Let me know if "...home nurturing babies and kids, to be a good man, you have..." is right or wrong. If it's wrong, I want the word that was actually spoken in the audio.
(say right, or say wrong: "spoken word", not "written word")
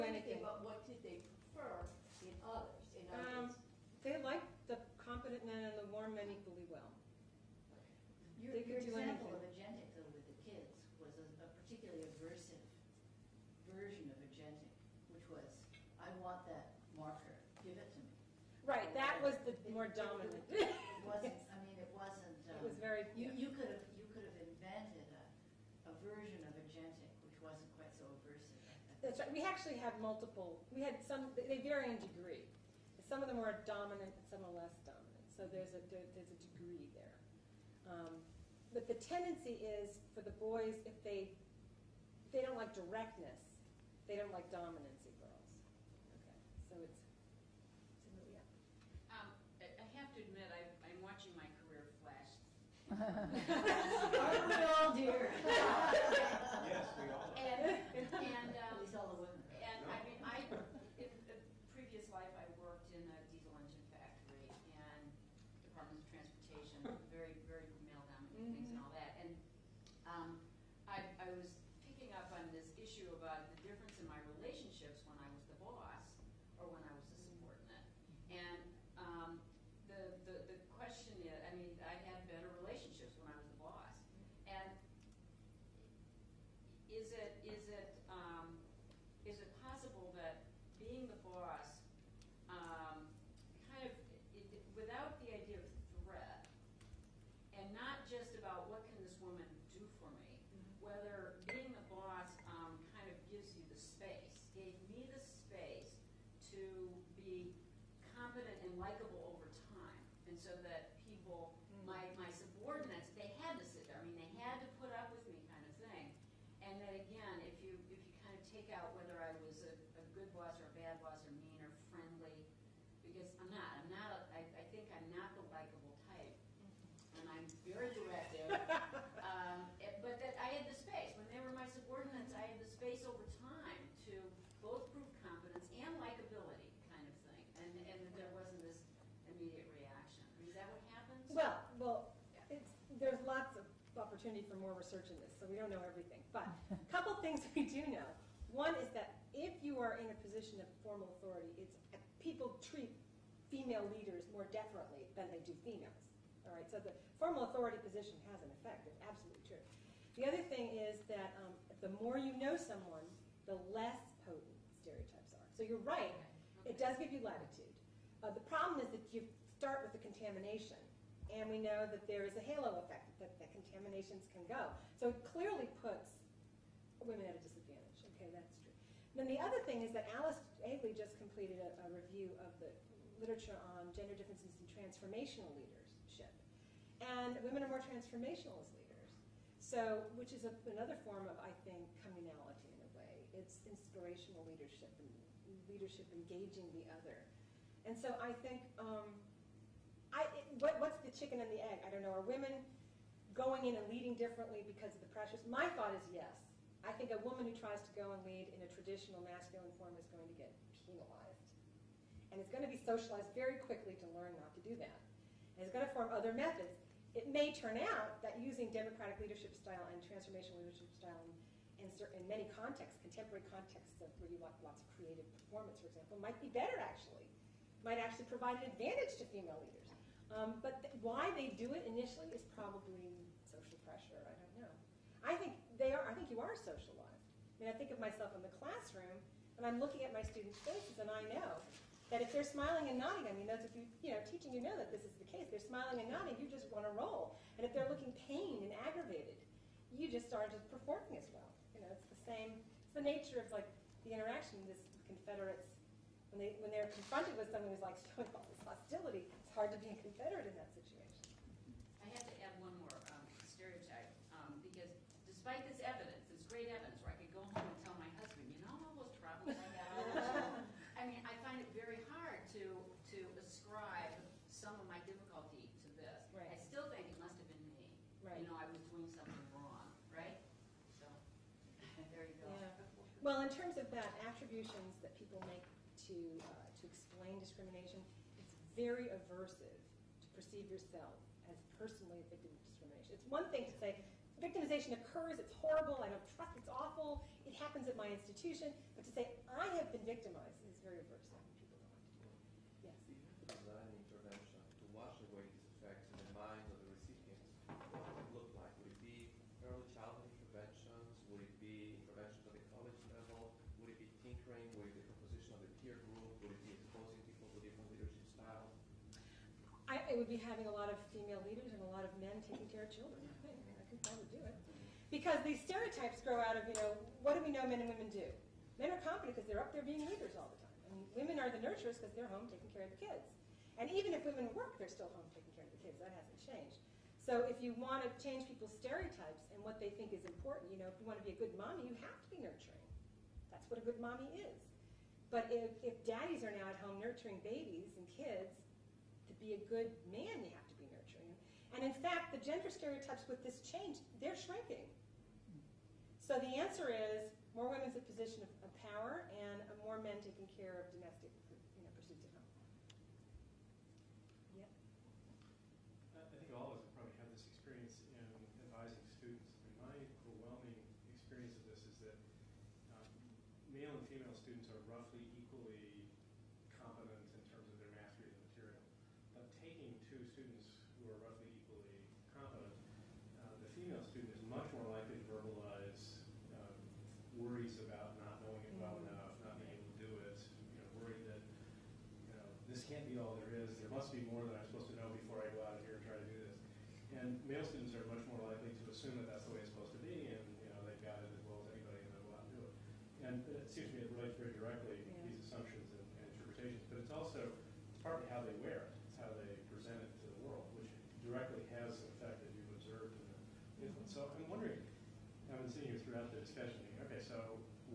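right.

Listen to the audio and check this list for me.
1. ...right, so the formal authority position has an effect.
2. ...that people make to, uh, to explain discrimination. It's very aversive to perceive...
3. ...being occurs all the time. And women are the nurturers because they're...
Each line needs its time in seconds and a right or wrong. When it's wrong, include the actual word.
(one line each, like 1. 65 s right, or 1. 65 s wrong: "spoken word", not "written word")
1. 156 s right
2. 284 s right
3. 329 s wrong: "leaders", not "occurs".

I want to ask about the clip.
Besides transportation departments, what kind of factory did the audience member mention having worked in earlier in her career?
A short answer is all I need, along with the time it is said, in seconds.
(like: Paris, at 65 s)
diesel engine factory, at 63 s.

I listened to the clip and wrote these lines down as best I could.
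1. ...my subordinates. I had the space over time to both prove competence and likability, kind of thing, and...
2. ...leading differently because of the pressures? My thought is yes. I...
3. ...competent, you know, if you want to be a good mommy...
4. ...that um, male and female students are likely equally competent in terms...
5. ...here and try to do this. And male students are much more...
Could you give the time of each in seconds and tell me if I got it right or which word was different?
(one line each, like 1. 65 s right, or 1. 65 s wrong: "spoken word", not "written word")
1. 131 s right
2. 203 s right
3. 340 s wrong: "important", not "competent"
4. 372 s wrong: "roughly", not "likely"
5. 395 s right.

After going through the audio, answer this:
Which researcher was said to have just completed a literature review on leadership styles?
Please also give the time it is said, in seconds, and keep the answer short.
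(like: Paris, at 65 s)
Alice Eagly, at 180 s.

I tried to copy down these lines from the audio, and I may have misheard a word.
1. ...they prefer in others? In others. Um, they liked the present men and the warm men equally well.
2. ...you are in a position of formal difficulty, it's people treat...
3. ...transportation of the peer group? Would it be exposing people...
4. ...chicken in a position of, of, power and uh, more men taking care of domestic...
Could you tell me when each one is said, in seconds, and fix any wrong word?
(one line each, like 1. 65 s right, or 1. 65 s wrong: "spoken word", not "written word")
1. 1 s wrong: "competent", not "present"
2. 149 s wrong: "authority", not "difficulty"
3. 315 s wrong: "composition", not "transportation"
4. 357 s wrong: "women", not "chicken".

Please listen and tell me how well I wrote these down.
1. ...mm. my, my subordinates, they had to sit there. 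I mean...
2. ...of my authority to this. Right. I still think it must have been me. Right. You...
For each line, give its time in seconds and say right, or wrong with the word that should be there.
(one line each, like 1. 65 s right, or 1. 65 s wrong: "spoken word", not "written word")
1. 111 s right
2. 274 s wrong: "difficulty", not "authority".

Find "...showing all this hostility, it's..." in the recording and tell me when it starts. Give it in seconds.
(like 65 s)
257 s.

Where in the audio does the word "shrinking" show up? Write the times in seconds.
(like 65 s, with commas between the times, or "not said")
354 s.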